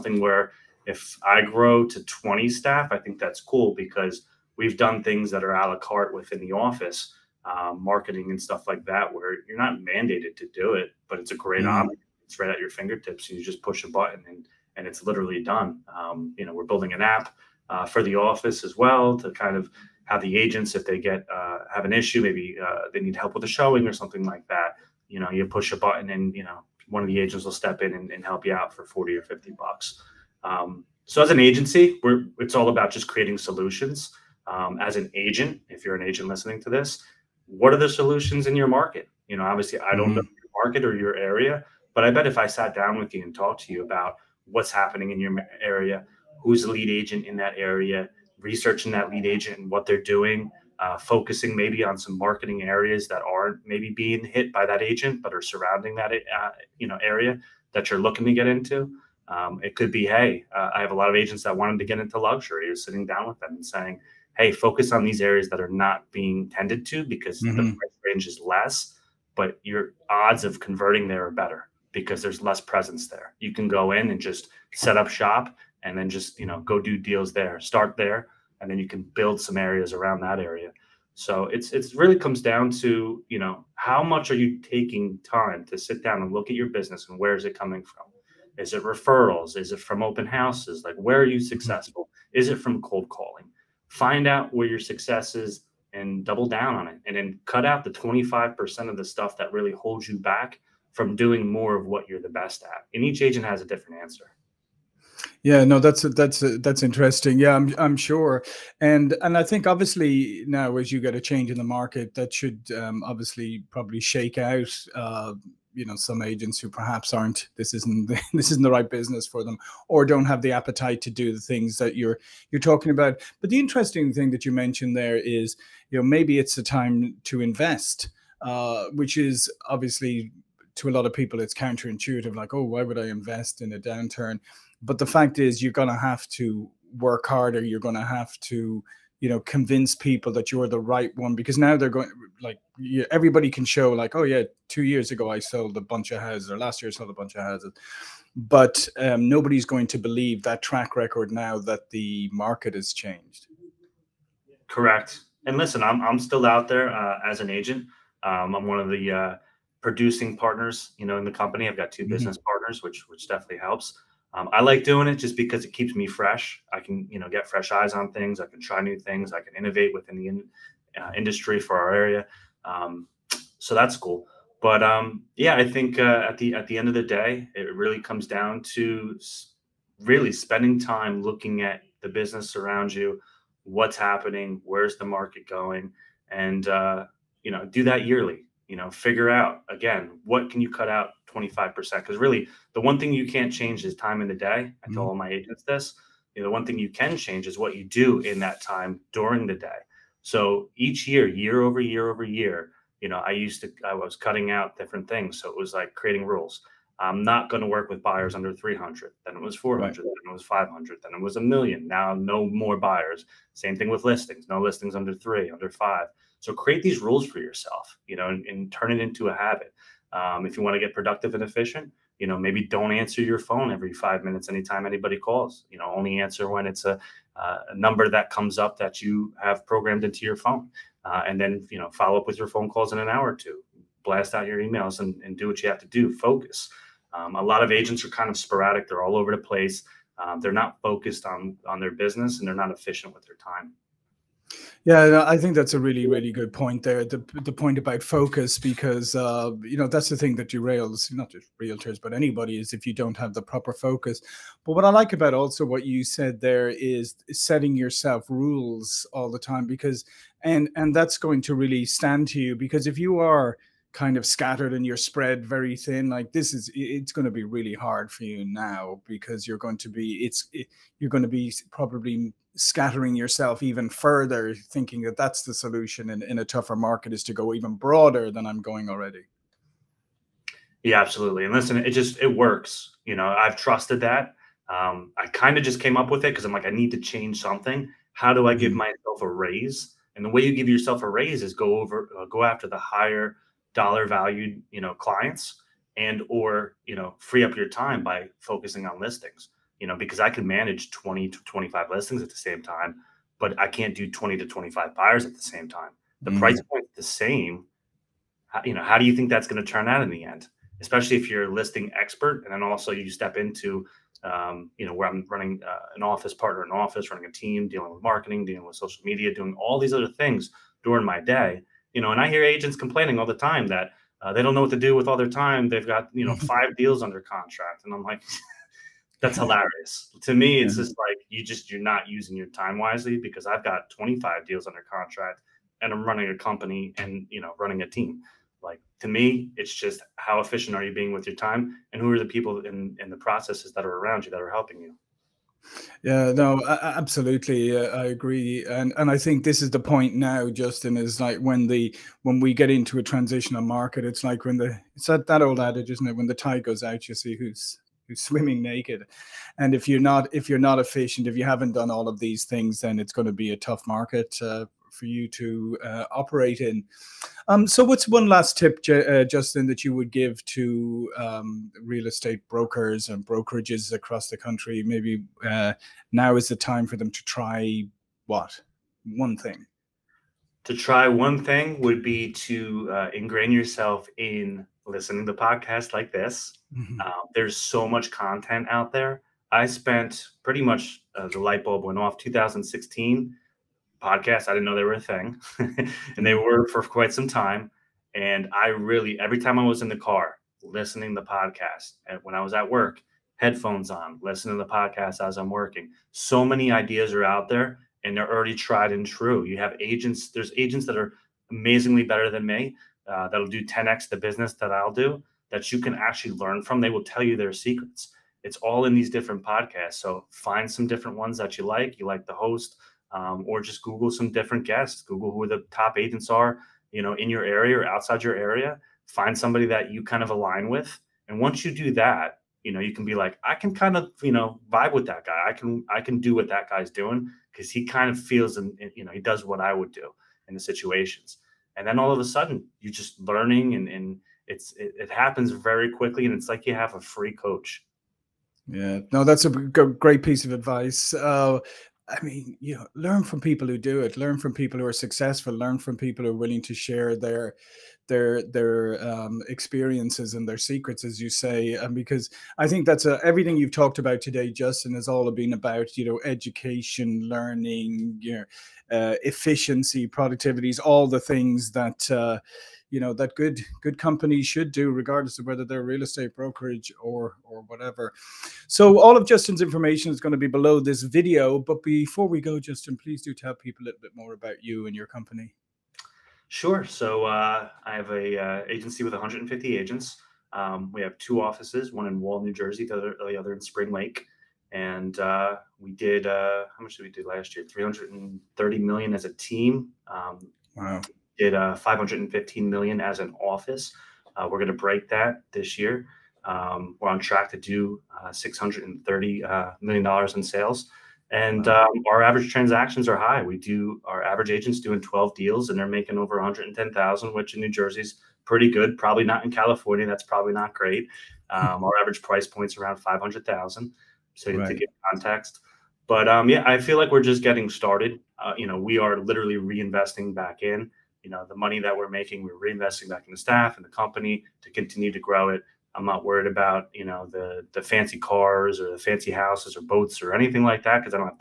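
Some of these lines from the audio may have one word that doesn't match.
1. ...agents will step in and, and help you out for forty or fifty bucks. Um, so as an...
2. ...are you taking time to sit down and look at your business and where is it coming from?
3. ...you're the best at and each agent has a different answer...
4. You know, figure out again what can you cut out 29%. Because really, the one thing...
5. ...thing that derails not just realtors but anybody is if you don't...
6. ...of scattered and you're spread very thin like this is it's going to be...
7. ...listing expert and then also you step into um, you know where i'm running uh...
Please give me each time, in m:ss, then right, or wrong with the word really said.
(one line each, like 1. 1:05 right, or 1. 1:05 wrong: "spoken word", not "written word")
1. 0:27 right
2. 1:24 right
3. 1:42 right
4. 3:08 wrong: "25", not "29"
5. 4:10 right
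6. 4:24 right
7. 5:11 right.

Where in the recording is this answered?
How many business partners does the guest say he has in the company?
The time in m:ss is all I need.
2:41.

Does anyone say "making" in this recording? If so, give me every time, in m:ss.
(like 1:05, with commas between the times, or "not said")
8:35, 8:52.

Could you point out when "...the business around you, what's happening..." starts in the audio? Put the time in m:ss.
3:02.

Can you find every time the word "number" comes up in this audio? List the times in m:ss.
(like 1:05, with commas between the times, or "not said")
3:47.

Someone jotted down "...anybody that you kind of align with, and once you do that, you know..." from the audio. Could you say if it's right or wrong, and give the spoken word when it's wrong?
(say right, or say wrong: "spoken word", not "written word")
wrong: "somebody", not "anybody".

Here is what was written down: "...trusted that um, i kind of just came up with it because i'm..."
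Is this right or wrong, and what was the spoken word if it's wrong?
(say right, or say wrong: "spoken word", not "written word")
right.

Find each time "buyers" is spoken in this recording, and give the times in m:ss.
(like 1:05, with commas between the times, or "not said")
3:28, 3:32, 5:04.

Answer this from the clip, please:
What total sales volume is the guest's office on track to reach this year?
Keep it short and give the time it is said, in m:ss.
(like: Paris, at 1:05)
$630 million, at 8:28.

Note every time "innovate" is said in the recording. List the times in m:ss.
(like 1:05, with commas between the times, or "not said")
2:49.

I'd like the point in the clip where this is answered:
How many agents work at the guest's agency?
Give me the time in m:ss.
8:09.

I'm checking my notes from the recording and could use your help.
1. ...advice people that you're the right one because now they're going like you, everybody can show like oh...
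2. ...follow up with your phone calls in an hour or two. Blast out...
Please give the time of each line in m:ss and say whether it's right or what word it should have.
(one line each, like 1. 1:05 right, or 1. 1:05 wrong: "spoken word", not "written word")
1. 2:19 wrong: "convince", not "advice"
2. 3:51 right.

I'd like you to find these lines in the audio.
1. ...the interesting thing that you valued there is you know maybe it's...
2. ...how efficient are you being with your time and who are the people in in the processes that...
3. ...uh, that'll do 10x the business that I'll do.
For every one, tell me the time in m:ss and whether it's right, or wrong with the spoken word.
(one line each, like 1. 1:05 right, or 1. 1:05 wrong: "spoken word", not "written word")
1. 2:03 wrong: "mentioned", not "valued"
2. 5:40 right
3. 6:53 right.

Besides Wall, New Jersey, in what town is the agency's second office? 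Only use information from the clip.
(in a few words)
Spring Lake.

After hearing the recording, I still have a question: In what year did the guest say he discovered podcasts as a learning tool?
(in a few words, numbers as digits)
2016.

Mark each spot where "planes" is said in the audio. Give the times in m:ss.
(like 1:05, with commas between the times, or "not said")
not said.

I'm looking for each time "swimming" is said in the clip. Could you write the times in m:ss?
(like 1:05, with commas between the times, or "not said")
5:58.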